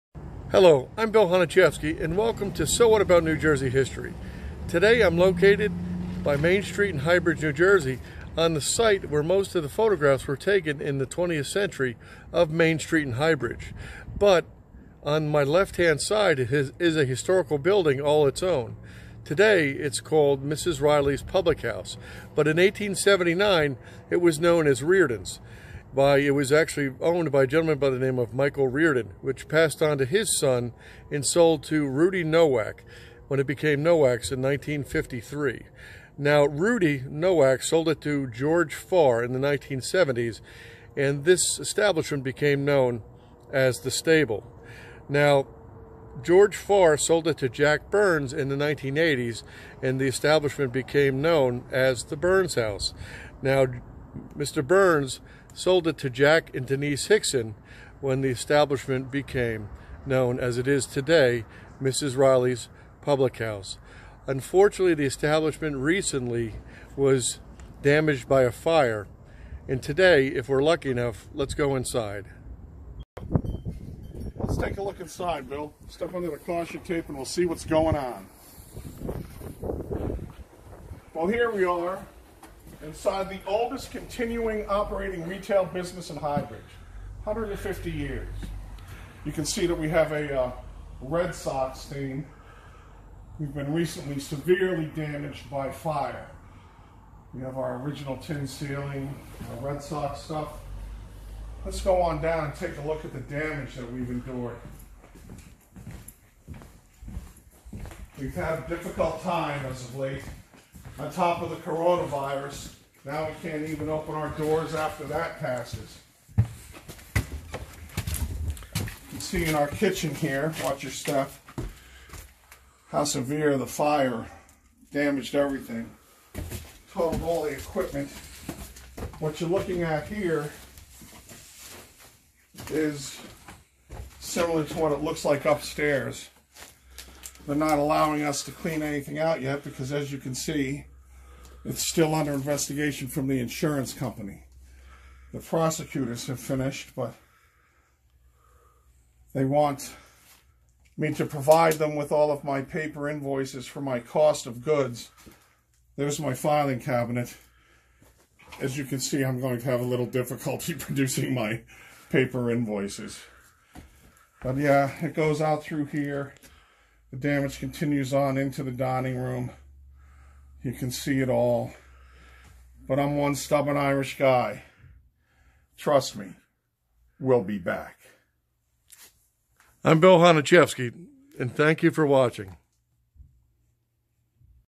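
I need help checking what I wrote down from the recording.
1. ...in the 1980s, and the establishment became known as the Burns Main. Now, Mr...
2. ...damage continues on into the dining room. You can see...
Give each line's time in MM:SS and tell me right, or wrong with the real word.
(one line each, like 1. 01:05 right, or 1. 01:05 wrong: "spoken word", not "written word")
1. 00:48 wrong: "House", not "Main"
2. 02:47 right.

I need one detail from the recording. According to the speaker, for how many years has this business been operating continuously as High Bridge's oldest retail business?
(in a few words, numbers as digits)
150 years.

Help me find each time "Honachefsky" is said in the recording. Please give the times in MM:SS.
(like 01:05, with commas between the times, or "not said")
00:01, 03:00.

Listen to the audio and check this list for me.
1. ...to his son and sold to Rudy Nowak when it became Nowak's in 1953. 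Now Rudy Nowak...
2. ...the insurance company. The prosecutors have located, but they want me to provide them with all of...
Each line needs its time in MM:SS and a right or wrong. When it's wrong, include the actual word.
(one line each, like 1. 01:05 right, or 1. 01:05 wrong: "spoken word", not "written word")
1. 00:29 right
2. 02:23 wrong: "finished", not "located".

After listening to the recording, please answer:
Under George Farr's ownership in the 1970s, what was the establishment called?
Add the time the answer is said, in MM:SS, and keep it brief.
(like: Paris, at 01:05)
The Stable, at 00:43.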